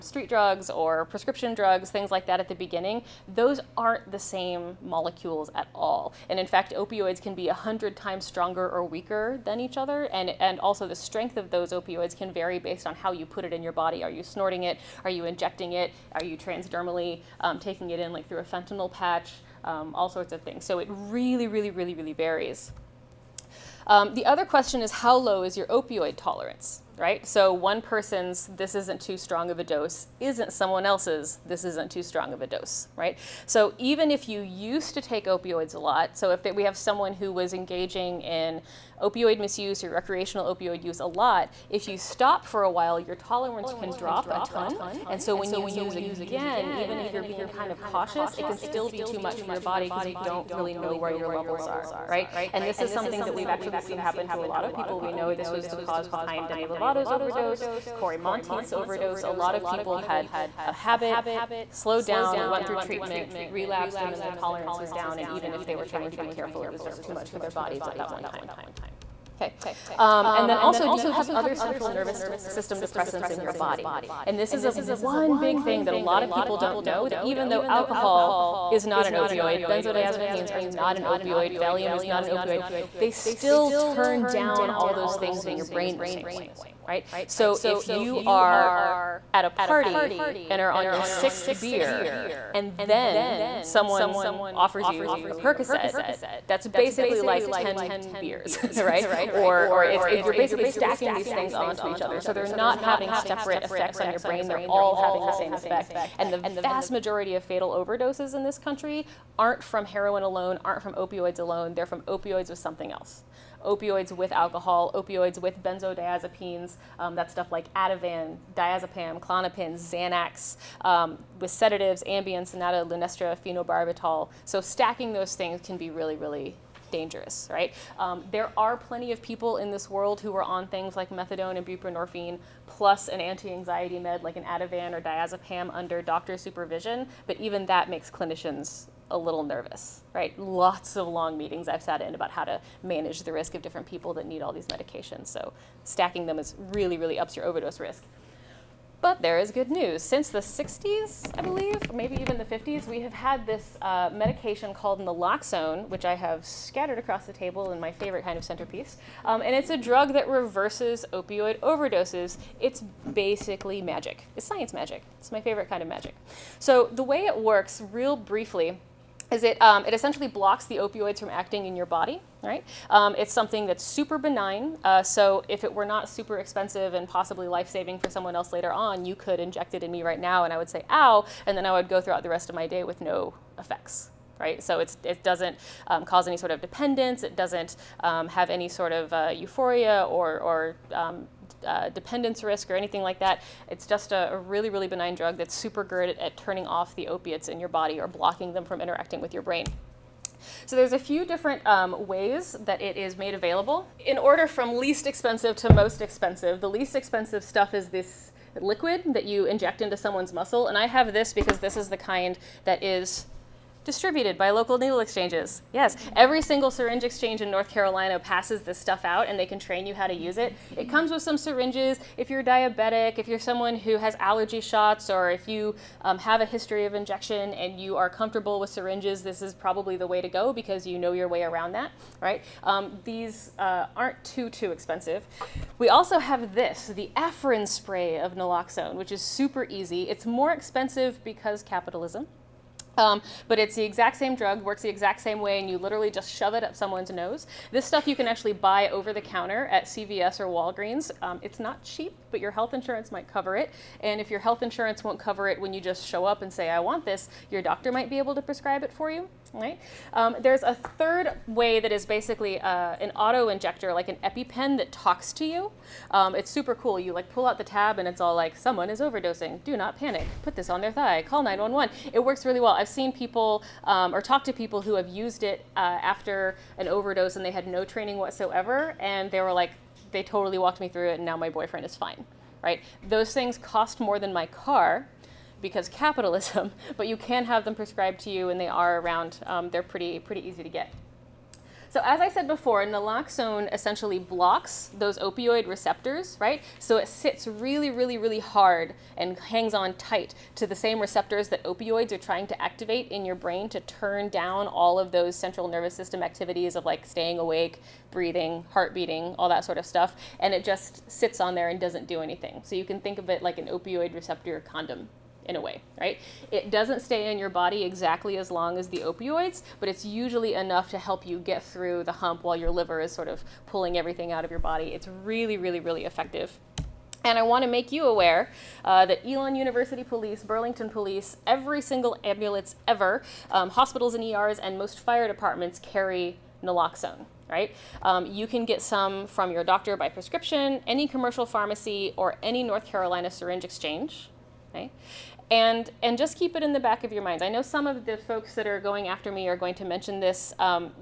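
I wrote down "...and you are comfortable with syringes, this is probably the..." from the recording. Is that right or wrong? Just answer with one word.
right.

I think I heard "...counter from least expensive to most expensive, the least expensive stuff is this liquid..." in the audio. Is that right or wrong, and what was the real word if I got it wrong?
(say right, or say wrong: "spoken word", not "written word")
wrong: "order", not "counter".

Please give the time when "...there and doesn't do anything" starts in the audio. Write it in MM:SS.
05:11.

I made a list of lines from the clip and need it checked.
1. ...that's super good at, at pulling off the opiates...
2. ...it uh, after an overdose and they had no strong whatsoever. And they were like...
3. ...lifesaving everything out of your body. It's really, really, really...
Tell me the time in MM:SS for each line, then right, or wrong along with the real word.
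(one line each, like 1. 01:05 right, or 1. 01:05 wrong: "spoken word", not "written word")
1. 03:15 wrong: "turning", not "pulling"
2. 04:35 wrong: "training", not "strong"
3. 05:23 wrong: "pulling", not "lifesaving".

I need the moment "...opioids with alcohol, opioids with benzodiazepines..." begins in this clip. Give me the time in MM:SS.
01:53.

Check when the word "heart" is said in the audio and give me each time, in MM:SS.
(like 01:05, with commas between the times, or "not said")
05:08.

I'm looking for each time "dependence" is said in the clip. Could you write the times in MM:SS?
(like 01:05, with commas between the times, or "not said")
03:06, 03:11.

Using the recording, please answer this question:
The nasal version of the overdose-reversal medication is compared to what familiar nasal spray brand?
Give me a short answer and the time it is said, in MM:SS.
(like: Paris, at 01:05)
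Afrin, at 03:57.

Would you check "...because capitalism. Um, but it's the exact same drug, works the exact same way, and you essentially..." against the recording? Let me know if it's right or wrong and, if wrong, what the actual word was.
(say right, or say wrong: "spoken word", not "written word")
wrong: "literally", not "essentially".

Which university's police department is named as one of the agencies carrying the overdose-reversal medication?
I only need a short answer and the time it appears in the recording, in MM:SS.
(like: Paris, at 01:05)
Elon University, at 05:29.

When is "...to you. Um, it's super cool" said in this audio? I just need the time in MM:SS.
04:25.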